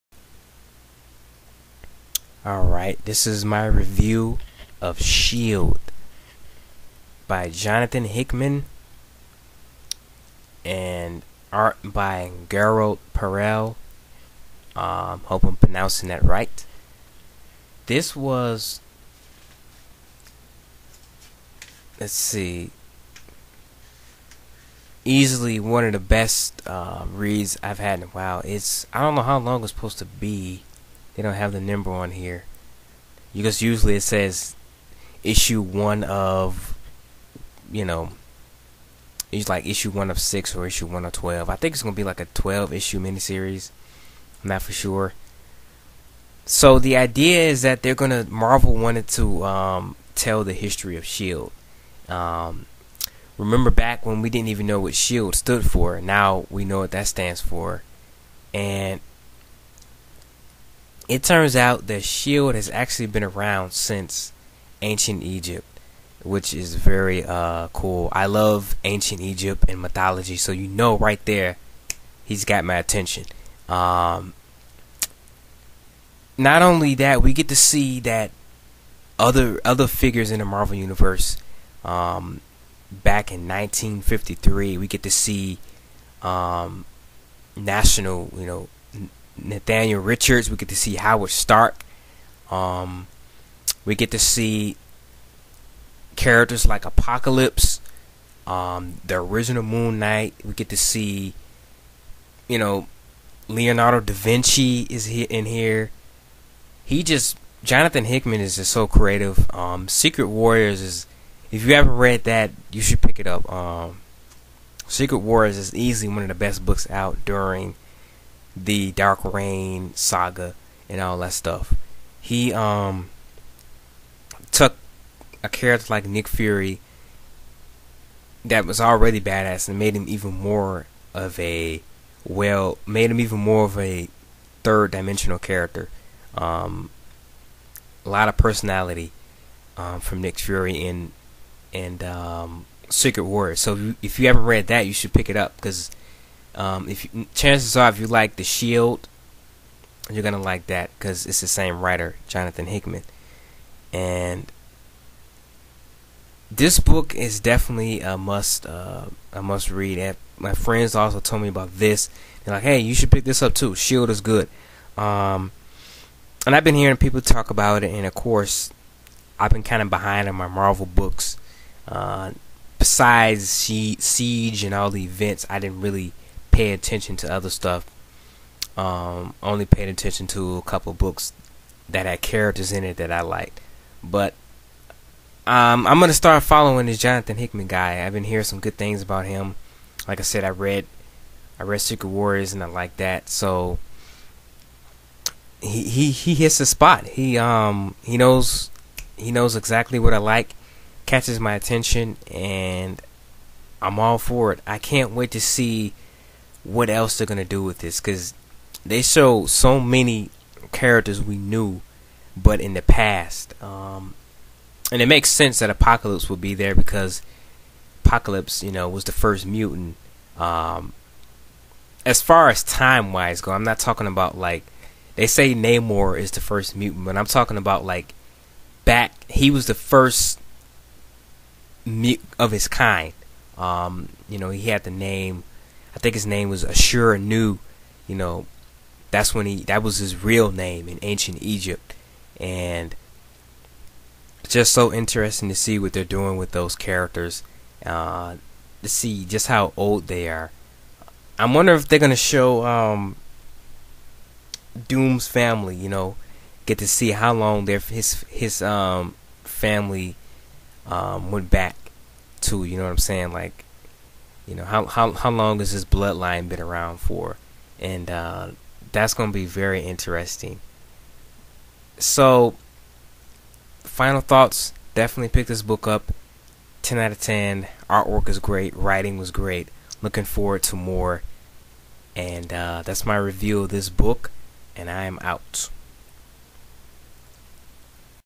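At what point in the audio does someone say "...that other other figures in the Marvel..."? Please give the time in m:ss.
1:17.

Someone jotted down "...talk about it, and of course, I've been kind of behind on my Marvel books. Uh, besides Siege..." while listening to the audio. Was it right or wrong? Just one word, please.
right.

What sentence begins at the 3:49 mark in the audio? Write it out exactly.
He was the first mute of his kind.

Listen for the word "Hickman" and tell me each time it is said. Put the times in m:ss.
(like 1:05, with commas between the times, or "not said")
0:08, 1:48, 2:32, 3:07.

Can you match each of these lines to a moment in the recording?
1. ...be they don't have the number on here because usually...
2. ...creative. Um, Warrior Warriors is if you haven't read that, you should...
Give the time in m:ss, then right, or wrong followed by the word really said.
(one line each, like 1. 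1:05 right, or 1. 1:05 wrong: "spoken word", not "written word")
1. 0:30 right
2. 1:48 wrong: "Secret", not "Warrior".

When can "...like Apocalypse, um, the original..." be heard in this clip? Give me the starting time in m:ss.
1:36.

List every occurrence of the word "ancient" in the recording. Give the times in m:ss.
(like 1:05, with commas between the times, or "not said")
1:04, 1:08, 4:01.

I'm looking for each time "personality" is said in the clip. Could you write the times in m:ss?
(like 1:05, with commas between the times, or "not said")
2:18.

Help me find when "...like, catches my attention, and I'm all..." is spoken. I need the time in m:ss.
3:20.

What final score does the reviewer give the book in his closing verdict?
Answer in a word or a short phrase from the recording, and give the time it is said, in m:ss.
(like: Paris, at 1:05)
10 out of 10, at 4:36.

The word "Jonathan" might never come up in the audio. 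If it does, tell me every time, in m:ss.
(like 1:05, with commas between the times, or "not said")
0:07, 1:47, 2:32, 3:06.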